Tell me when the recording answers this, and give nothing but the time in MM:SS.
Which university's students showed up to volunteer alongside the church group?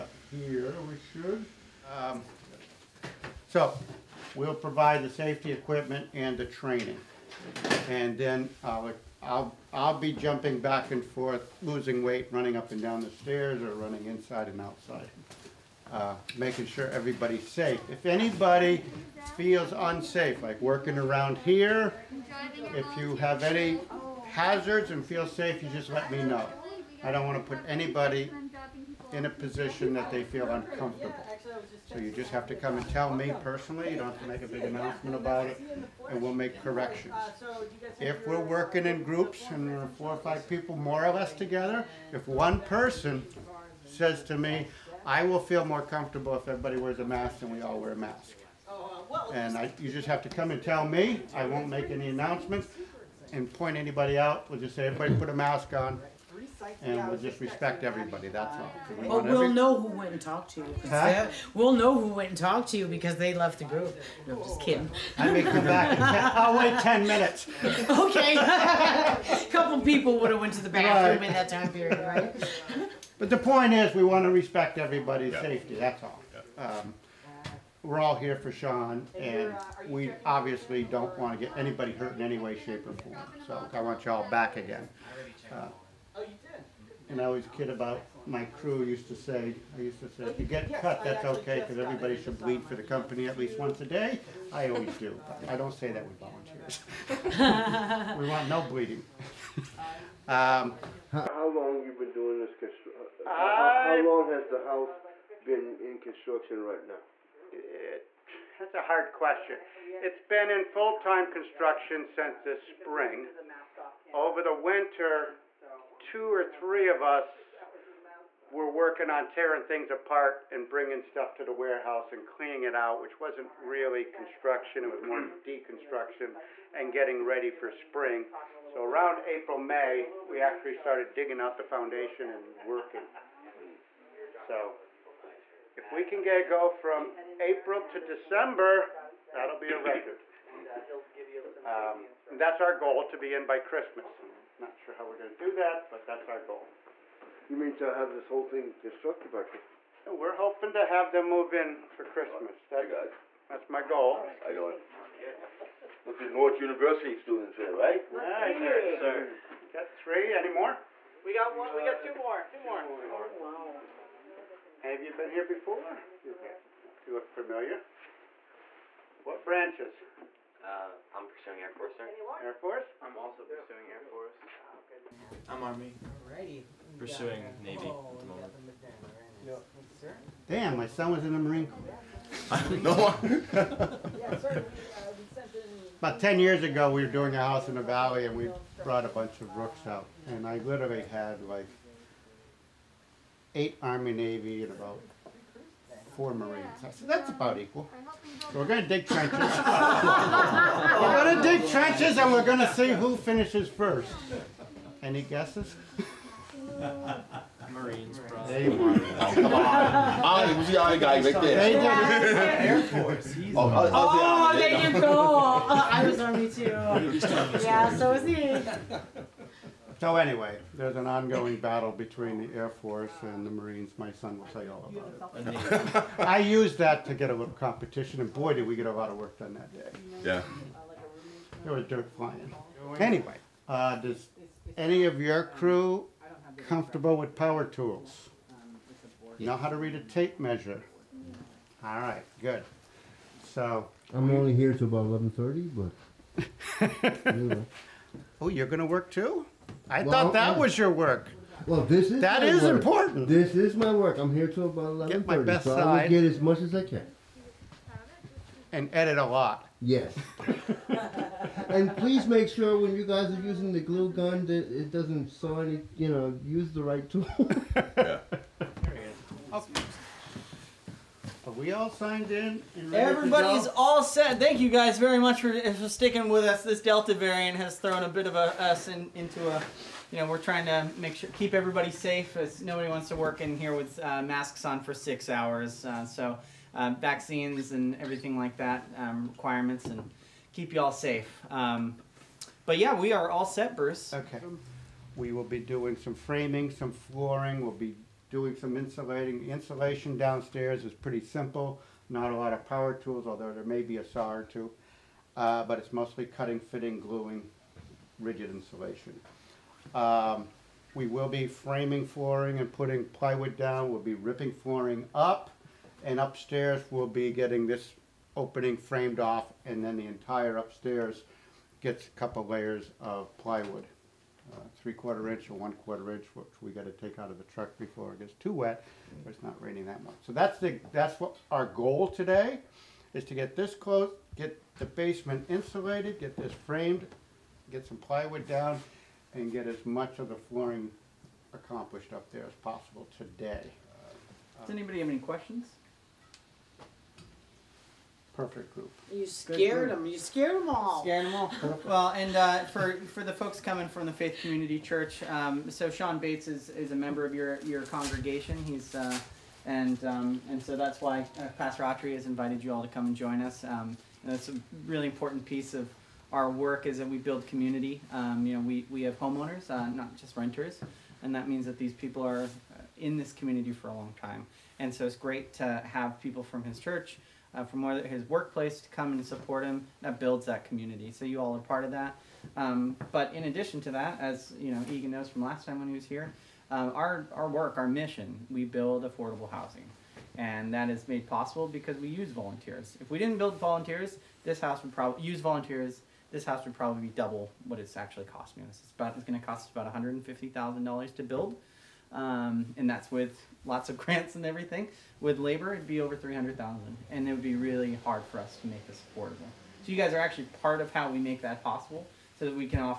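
02:36.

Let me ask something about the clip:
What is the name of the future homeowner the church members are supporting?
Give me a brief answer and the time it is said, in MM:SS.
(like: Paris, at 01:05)
Sean Bates, at 05:55.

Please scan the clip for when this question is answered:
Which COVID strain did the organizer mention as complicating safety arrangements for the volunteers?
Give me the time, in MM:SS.
04:36.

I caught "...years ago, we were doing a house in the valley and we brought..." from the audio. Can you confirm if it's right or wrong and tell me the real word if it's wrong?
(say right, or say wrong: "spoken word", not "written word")
right.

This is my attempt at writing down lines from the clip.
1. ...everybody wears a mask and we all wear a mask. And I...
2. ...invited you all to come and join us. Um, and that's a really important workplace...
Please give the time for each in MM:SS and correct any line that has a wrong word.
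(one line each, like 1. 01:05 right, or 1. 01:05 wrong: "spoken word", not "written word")
1. 00:46 right
2. 06:02 wrong: "piece", not "workplace".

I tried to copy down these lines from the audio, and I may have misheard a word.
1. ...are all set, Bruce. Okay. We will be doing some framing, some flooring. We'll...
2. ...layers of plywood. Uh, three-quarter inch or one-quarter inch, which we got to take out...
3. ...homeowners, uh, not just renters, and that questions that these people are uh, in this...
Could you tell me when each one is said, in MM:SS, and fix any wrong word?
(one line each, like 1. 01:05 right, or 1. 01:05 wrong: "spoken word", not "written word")
1. 04:53 right
2. 05:22 right
3. 06:09 wrong: "means", not "questions".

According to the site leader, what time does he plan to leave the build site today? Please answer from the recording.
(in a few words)
11:30.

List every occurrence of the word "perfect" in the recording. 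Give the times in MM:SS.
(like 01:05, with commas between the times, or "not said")
05:48.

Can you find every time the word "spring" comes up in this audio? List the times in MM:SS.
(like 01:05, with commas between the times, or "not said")
01:52, 02:07.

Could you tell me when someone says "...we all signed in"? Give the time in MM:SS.
04:31.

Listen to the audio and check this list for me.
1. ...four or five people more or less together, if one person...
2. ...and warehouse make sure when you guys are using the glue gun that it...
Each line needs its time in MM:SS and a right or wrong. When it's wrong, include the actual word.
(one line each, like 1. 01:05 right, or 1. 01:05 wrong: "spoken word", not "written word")
1. 00:39 right
2. 04:21 wrong: "please", not "warehouse".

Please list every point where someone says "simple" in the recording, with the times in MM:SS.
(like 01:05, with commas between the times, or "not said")
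05:01.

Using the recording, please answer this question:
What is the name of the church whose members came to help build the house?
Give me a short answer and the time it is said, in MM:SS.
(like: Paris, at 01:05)
Faith Community Church, at 05:54.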